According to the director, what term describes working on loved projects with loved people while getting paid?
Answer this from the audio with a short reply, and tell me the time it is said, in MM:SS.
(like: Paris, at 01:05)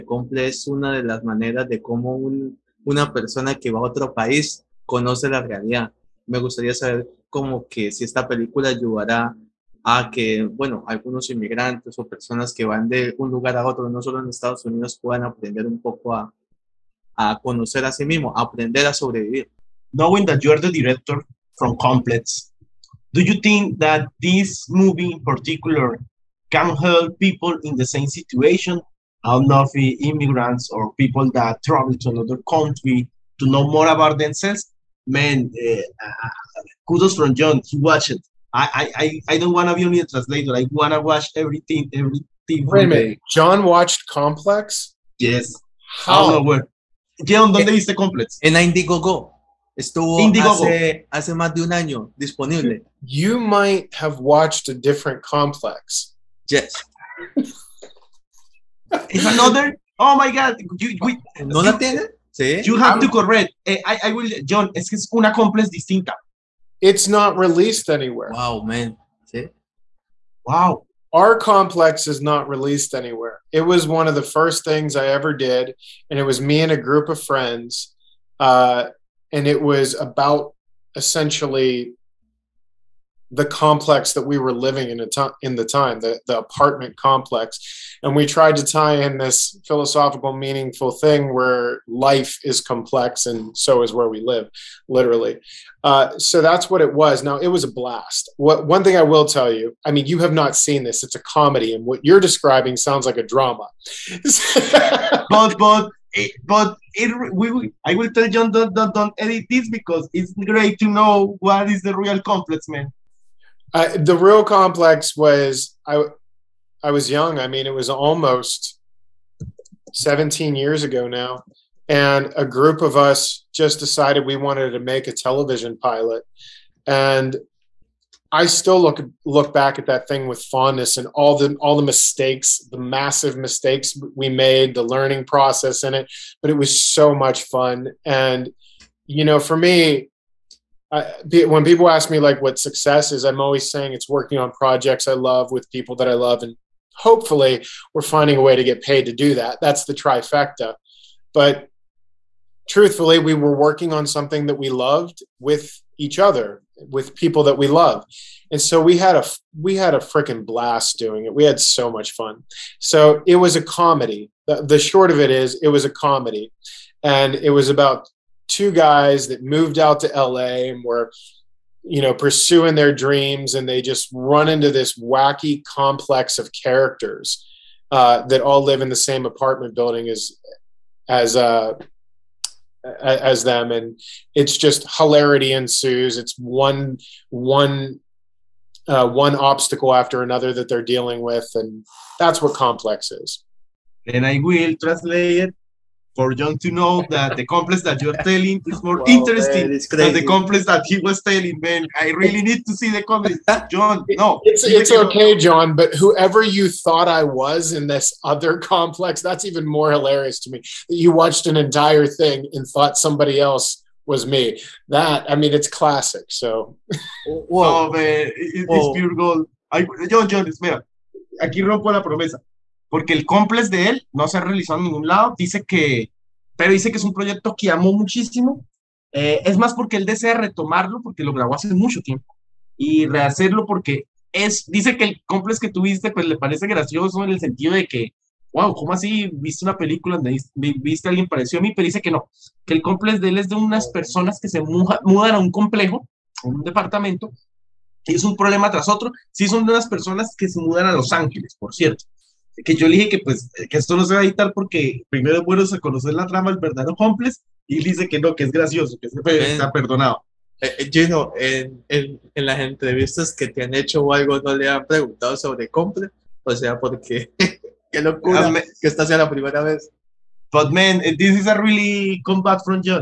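the trifecta, at 02:29.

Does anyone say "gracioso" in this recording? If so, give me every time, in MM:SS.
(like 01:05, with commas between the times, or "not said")
03:56, 04:18.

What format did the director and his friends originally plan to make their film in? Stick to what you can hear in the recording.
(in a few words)
television pilot.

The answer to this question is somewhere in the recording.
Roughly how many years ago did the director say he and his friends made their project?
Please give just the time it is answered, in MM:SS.
01:57.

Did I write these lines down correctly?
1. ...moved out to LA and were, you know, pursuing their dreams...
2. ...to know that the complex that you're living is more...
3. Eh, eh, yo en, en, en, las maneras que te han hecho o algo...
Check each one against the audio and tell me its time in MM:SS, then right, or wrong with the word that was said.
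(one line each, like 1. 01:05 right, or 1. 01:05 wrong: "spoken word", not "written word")
1. 02:49 right
2. 03:16 wrong: "telling", not "living"
3. 04:20 wrong: "entrevistas", not "maneras".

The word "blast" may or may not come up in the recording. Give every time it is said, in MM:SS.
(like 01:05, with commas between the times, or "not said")
01:37, 02:40.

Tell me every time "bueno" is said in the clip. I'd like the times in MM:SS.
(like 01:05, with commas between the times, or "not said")
00:10, 04:15.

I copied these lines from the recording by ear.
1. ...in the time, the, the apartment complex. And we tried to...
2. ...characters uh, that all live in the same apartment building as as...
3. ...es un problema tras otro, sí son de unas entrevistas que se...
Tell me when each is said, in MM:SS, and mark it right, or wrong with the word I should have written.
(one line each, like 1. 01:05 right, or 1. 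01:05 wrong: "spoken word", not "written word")
1. 01:25 right
2. 02:56 right
3. 04:08 wrong: "personas", not "entrevistas".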